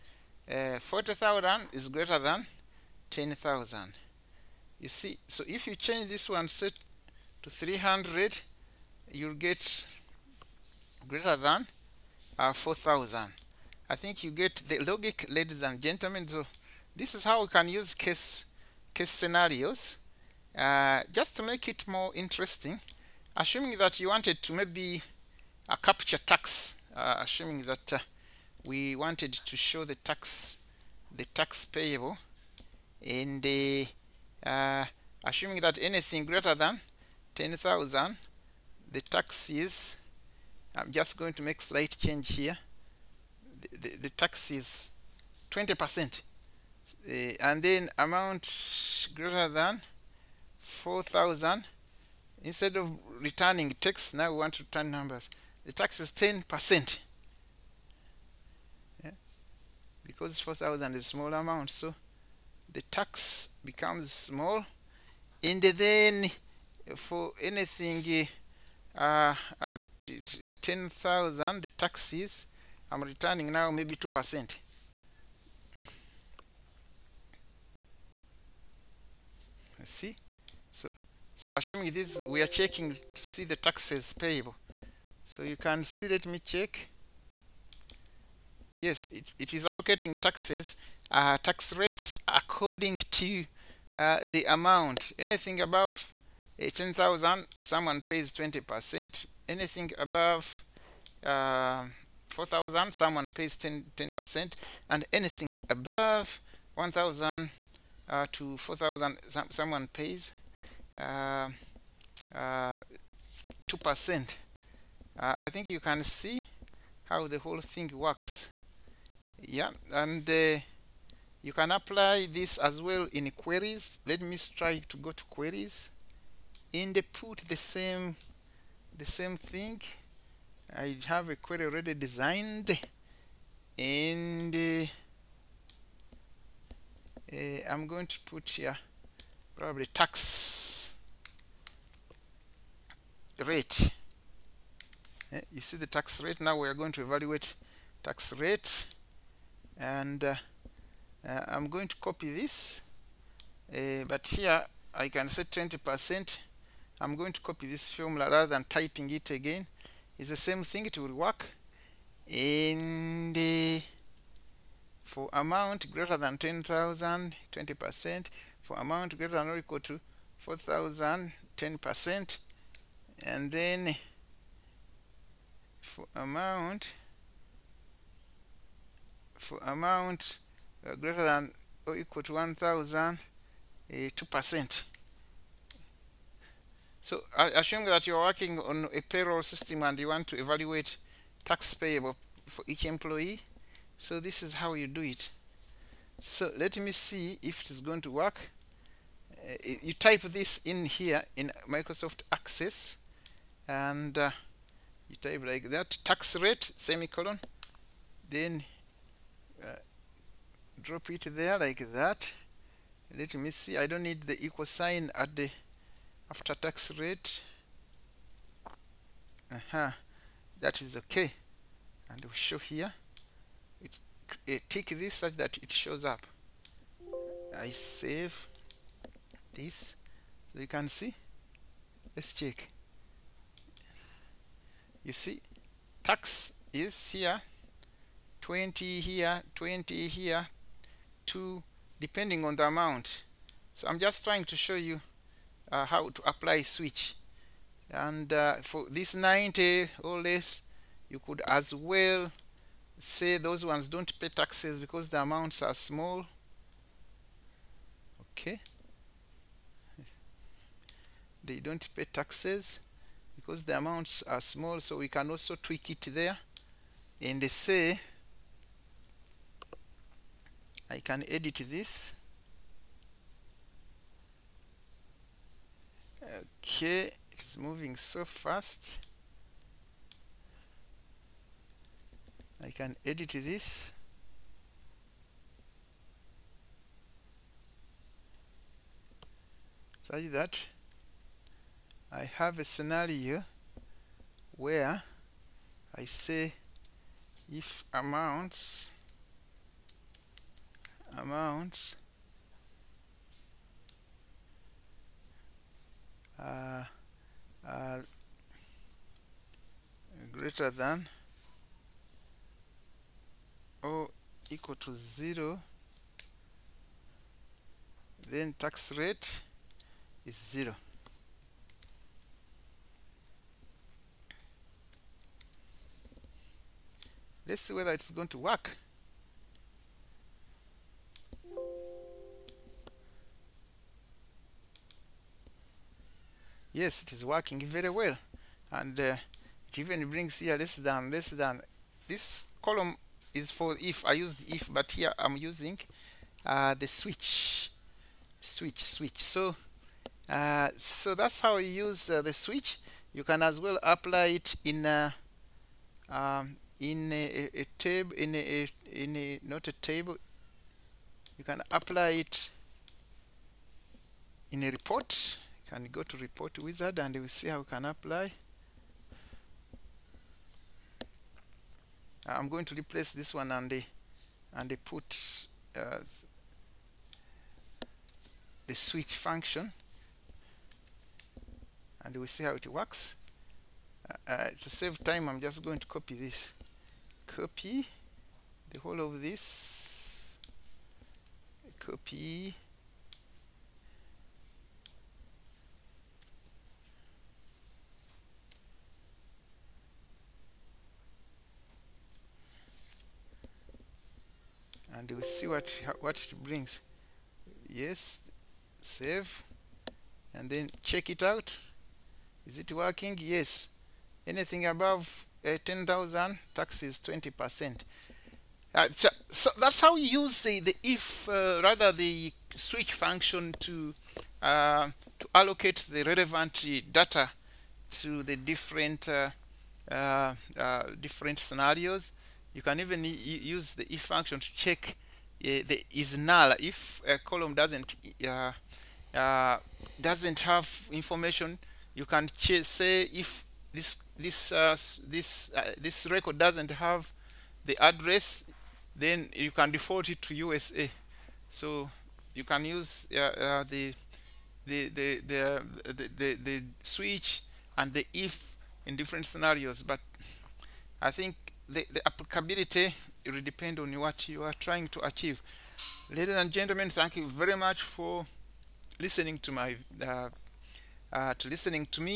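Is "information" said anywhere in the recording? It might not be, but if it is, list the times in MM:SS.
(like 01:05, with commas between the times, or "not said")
07:20.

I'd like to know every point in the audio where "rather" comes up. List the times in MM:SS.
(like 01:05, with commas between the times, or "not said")
02:38, 07:01.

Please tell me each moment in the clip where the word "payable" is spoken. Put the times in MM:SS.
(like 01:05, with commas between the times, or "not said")
00:31, 01:24, 03:11.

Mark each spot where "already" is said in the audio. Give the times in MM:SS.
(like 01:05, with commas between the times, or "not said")
02:11.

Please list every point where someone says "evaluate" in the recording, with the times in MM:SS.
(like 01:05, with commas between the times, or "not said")
02:27, 03:10.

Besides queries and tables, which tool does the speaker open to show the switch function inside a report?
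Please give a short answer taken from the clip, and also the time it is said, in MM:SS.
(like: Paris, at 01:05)
report wizard, at 06:06.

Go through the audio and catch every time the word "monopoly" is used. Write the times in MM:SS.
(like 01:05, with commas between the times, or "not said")
not said.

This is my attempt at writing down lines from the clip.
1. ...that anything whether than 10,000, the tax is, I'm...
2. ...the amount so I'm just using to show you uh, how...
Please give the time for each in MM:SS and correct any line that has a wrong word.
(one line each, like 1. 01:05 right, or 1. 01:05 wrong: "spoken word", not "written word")
1. 00:35 wrong: "greater", not "whether"
2. 04:02 wrong: "trying", not "using".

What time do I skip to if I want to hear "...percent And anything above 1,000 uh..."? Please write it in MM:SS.
01:44.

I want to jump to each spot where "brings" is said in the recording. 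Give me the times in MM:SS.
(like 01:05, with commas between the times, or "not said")
05:40, 06:46.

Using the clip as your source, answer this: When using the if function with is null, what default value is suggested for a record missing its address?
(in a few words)
USA.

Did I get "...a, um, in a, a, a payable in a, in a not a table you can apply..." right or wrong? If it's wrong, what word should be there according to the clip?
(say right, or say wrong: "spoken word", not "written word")
wrong: "table", not "payable".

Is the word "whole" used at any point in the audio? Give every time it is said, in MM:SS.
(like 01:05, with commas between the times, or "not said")
01:57, 06:28.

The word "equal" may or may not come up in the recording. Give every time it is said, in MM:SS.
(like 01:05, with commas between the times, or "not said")
02:49, 03:01, 03:34, 05:14.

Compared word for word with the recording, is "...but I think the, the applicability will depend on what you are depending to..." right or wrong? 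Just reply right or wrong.
wrong.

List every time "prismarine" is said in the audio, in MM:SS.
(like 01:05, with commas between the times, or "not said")
not said.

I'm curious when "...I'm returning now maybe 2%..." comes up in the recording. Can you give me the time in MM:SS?
01:12.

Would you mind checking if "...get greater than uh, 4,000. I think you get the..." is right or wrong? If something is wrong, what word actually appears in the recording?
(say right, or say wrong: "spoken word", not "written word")
right.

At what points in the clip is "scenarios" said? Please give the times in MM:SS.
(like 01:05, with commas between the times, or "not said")
00:19, 04:52, 07:11, 07:39.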